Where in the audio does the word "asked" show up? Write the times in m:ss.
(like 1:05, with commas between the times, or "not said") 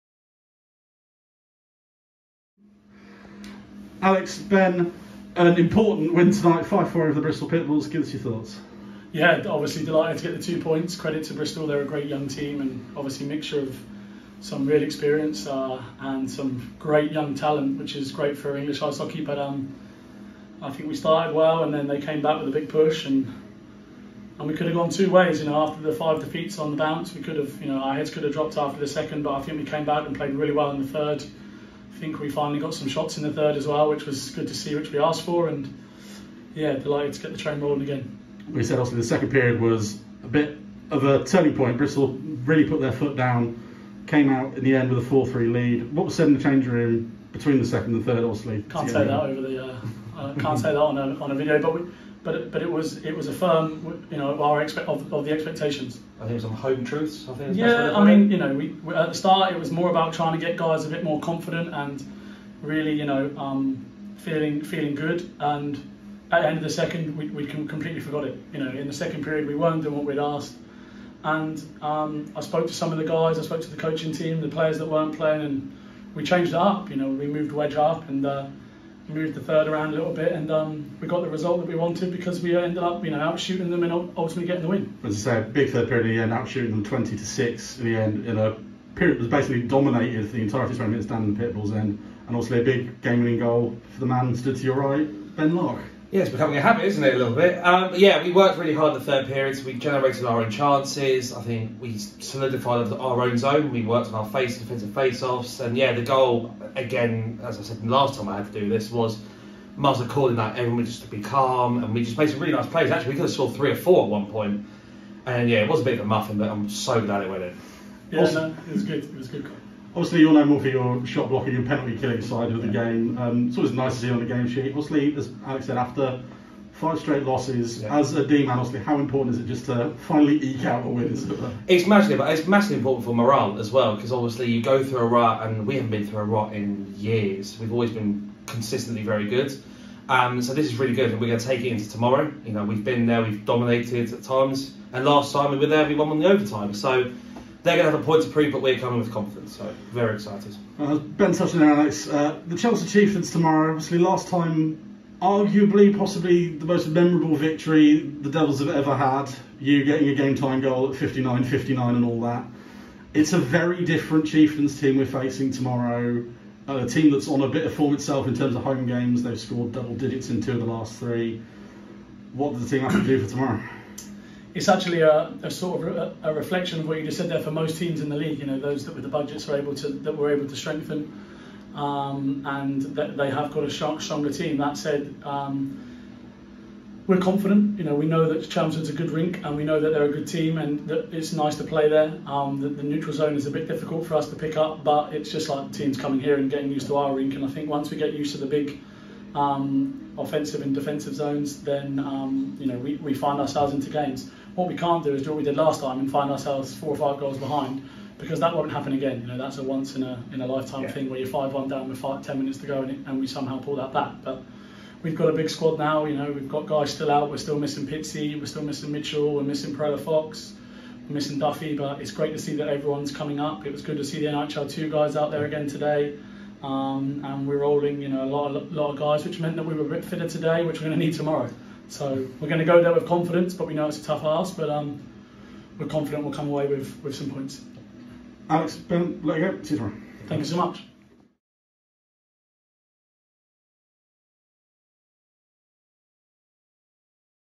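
0:34, 1:10.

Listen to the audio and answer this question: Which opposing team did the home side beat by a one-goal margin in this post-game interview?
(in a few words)
Bristol Pitbulls.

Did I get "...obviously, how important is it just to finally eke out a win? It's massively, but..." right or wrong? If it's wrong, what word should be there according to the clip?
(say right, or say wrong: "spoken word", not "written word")
right.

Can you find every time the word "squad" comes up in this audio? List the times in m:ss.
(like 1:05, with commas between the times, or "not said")
3:35.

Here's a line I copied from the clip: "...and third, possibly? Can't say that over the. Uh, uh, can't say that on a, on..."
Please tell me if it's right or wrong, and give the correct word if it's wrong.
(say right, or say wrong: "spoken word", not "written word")
wrong: "obviously", not "possibly".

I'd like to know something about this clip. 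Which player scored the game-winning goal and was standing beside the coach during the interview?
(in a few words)
Ben Lock.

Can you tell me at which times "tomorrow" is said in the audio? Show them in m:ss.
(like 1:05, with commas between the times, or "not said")
2:21, 2:33, 2:45, 2:53, 3:51, 3:59.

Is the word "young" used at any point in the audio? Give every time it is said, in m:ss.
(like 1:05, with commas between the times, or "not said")
0:12, 0:17.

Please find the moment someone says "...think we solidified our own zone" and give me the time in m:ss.
1:41.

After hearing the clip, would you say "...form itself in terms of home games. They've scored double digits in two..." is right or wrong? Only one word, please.
right.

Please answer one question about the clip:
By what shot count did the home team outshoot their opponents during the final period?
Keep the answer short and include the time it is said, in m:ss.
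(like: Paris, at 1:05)
20 to 6, at 1:26.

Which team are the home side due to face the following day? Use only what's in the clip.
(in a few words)
Chelmsford Chieftains.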